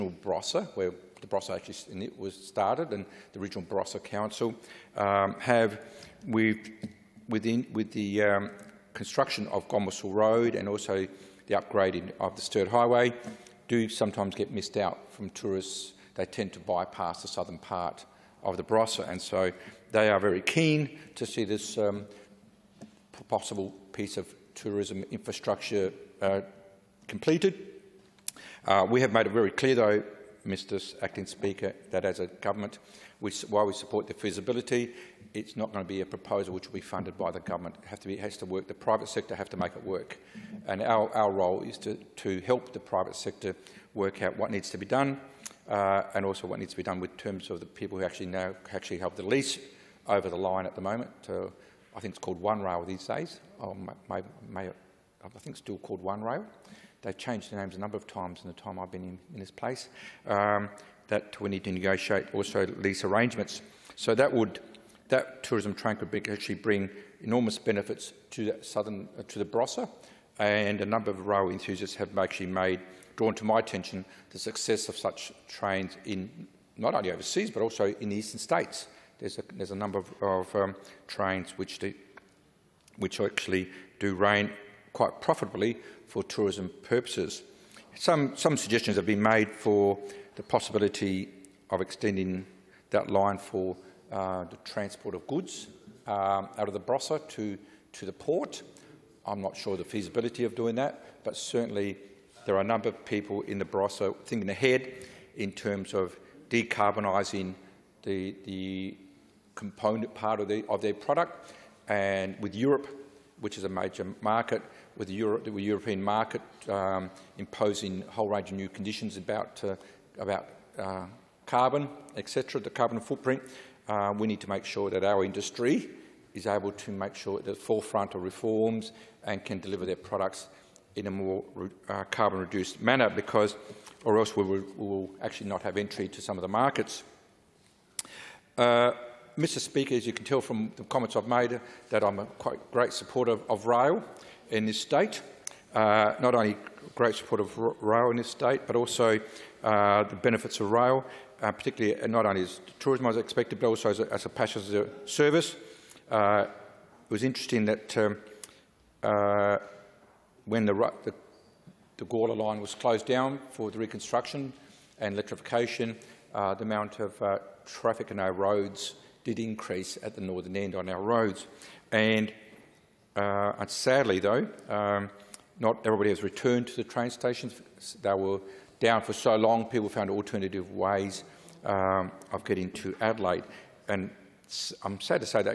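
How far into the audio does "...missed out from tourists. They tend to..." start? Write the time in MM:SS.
00:14.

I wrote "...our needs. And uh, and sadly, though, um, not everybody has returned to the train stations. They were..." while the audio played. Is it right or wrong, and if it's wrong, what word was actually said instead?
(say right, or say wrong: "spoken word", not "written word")
wrong: "roads", not "needs".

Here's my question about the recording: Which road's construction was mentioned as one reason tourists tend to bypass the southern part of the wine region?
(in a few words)
Gomersal Road.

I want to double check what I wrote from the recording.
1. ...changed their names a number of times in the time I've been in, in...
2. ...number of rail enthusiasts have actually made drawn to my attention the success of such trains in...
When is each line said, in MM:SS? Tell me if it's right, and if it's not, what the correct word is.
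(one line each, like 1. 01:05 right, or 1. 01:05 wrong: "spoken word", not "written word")
1. 00:57 right
2. 01:10 right.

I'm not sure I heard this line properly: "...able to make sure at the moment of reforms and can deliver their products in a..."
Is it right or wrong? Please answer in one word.
wrong.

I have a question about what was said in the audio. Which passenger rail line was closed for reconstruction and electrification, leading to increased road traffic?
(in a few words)
Gawler line.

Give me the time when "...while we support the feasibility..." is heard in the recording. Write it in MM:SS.
00:33.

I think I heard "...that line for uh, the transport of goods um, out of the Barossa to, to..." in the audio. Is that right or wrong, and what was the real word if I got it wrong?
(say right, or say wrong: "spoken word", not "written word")
right.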